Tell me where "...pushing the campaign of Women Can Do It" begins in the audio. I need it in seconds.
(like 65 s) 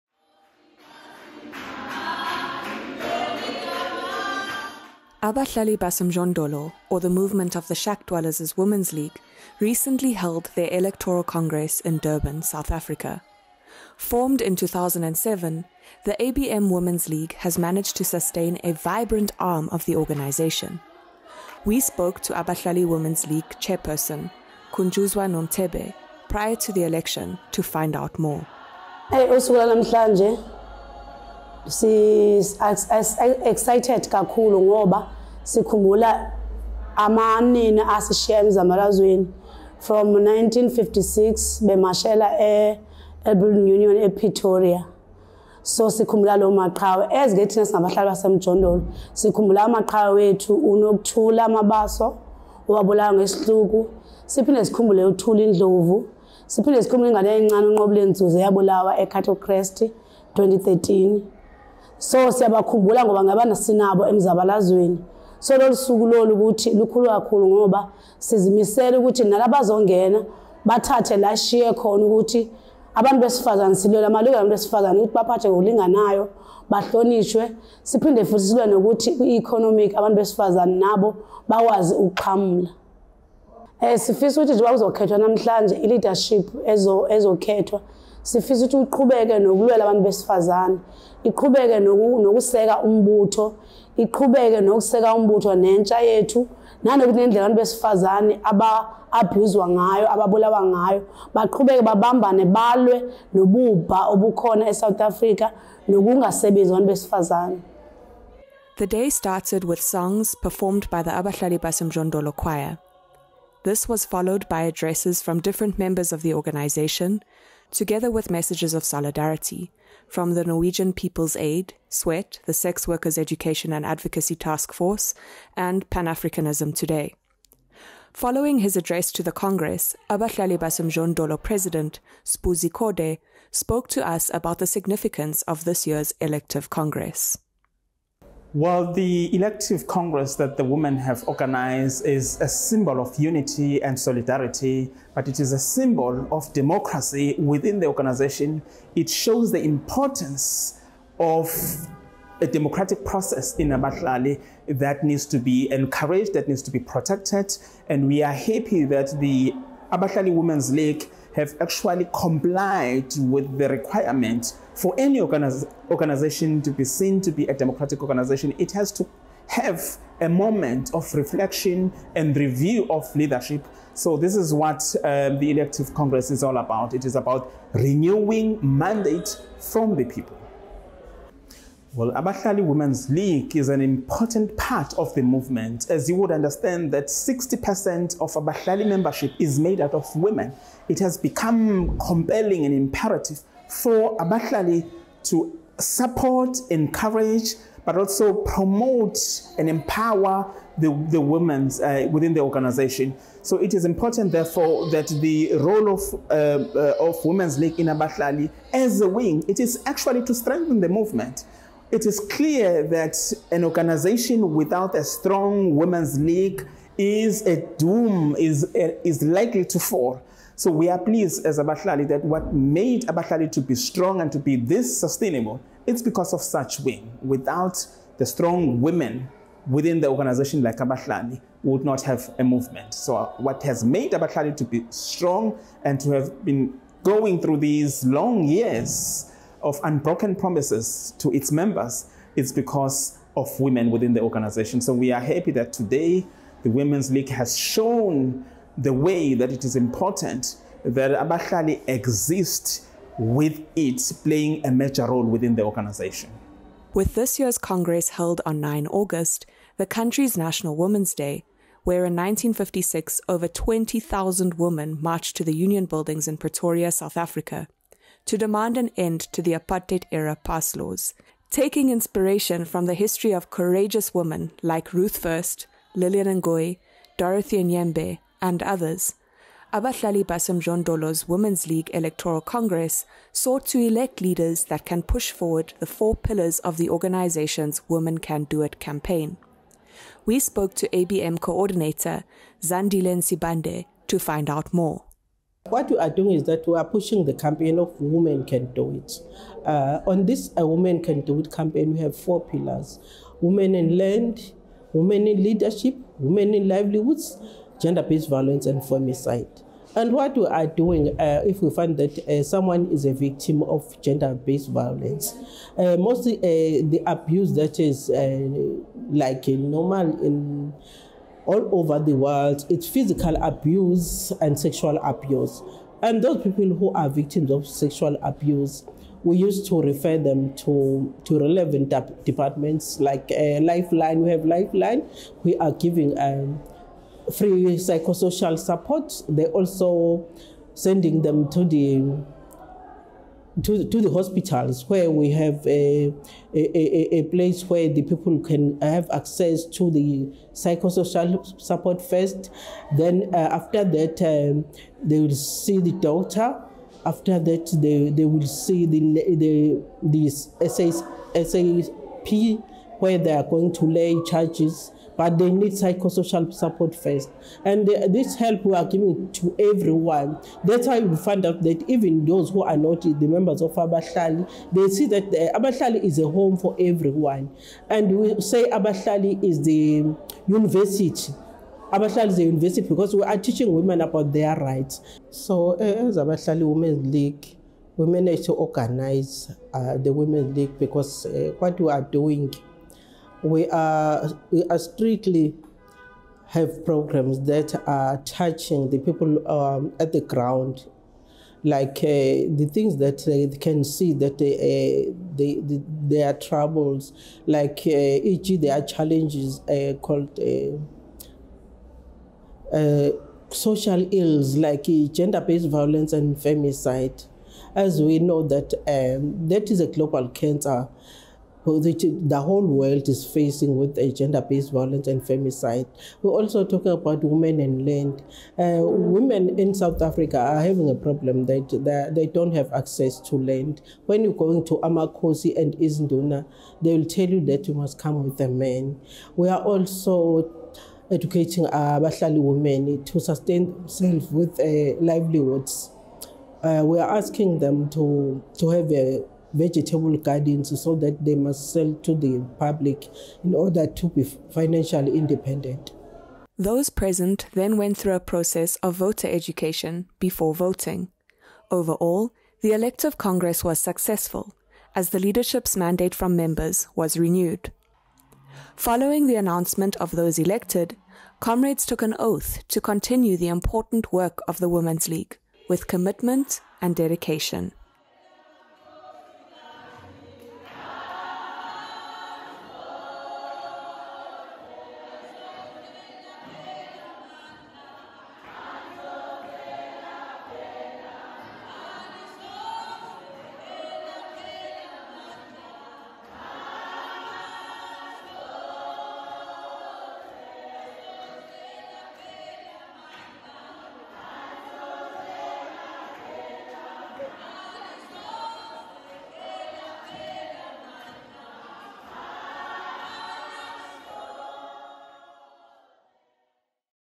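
296 s.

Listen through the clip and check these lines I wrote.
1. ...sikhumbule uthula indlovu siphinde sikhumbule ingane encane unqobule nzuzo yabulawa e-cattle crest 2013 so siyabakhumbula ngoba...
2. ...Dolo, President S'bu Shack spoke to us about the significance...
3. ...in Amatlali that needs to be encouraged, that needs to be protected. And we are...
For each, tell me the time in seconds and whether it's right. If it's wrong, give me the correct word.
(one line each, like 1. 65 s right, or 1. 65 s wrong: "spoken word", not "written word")
1. 54 s right
2. 131 s wrong: "Zikode", not "Shack"
3. 153 s right.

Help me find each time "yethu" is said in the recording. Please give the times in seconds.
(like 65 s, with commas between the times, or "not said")
96 s.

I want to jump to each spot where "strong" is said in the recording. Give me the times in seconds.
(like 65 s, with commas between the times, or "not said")
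215 s, 223 s, 228 s, 234 s.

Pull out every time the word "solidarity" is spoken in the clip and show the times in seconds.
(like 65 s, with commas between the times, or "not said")
118 s, 143 s.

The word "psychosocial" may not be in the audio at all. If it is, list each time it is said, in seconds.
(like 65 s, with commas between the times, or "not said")
337 s, 350 s, 365 s.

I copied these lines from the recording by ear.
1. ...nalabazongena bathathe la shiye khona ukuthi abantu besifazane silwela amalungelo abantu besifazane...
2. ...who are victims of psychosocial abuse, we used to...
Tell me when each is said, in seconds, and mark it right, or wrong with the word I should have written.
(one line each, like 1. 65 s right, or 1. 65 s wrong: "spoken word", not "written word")
1. 69 s right
2. 326 s wrong: "sexual", not "psychosocial".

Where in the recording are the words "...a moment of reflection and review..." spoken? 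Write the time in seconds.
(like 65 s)
170 s.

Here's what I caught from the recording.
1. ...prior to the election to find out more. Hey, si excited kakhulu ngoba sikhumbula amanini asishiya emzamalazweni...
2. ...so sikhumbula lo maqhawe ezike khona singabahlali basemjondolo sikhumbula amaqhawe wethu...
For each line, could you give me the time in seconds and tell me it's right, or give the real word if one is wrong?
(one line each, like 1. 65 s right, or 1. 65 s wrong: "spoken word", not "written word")
1. 26 s right
2. 45 s wrong: "thina", not "khona".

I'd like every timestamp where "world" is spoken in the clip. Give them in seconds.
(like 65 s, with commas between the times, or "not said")
322 s, 422 s.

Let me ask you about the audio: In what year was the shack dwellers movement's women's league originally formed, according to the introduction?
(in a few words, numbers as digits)
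2007.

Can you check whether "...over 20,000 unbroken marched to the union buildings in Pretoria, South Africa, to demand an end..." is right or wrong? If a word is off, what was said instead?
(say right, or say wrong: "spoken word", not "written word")
wrong: "women", not "unbroken".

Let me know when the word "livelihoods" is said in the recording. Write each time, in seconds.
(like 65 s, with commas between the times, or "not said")
306 s, 445 s.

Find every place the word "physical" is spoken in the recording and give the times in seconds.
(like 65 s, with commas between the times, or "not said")
322 s.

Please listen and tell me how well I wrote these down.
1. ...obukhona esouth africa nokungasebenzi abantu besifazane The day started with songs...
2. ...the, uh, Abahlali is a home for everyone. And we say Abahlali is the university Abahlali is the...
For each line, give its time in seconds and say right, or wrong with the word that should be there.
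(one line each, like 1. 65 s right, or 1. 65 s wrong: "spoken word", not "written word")
1. 104 s right
2. 375 s right.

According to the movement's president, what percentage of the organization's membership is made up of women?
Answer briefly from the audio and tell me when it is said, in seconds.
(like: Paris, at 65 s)
60%, at 187 s.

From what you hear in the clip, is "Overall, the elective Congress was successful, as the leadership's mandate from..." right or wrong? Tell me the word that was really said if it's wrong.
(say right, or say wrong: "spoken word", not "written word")
right.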